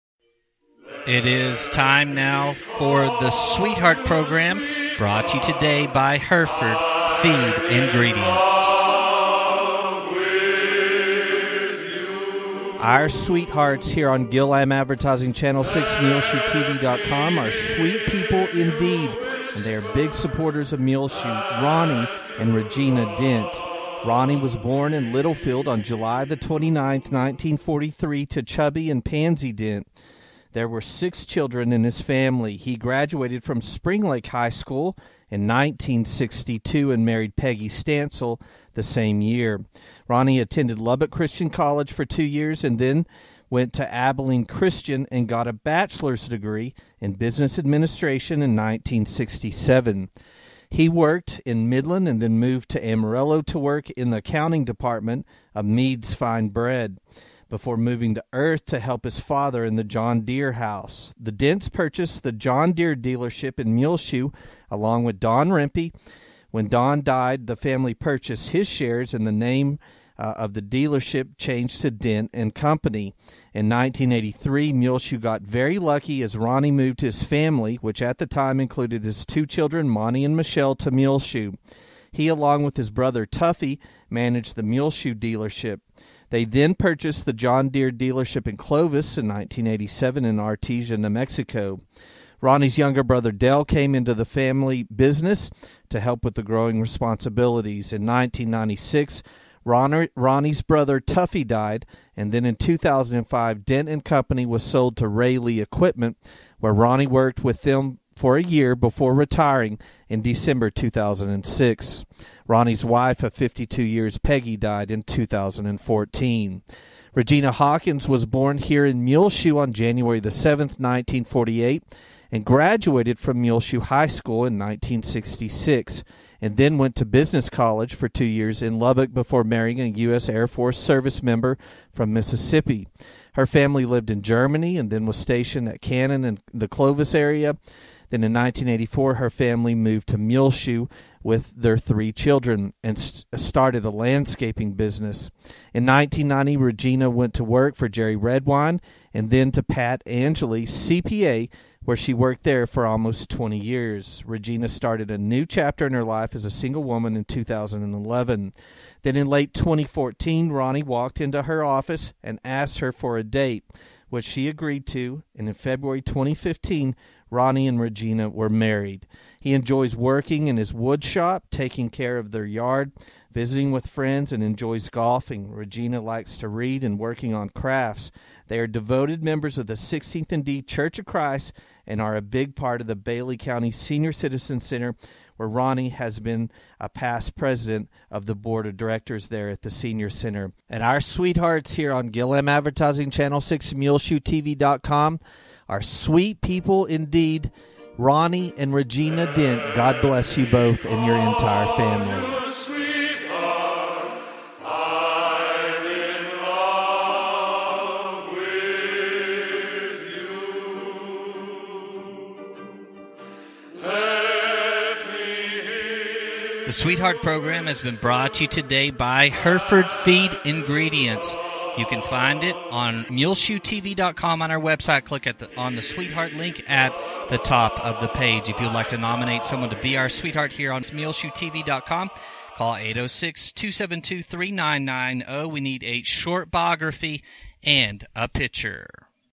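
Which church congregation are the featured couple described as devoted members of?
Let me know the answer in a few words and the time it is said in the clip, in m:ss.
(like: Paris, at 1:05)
16th and D Church of Christ, at 2:59.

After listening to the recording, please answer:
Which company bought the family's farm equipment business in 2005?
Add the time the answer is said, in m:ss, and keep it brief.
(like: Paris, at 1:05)
Rayleigh Equipment, at 1:45.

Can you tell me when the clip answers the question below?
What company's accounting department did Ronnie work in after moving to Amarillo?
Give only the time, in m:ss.
0:55.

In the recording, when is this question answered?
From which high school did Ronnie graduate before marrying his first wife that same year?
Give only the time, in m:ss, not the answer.
0:33.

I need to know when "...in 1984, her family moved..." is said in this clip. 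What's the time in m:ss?
2:18.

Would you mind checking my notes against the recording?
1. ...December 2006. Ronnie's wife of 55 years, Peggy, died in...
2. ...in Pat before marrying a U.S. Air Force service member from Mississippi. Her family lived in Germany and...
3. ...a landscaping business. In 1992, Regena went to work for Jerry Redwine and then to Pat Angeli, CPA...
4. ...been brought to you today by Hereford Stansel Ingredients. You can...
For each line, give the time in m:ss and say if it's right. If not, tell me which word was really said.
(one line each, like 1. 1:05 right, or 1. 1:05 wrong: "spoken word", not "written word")
1. 1:50 wrong: "52", not "55"
2. 2:08 wrong: "Lubbock", not "Pat"
3. 2:23 wrong: "1990", not "1992"
4. 3:37 wrong: "Feed", not "Stansel".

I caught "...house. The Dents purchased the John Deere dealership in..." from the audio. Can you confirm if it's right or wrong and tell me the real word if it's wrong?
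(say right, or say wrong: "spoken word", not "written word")
right.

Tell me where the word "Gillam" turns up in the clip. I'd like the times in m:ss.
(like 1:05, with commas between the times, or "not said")
0:14, 3:12.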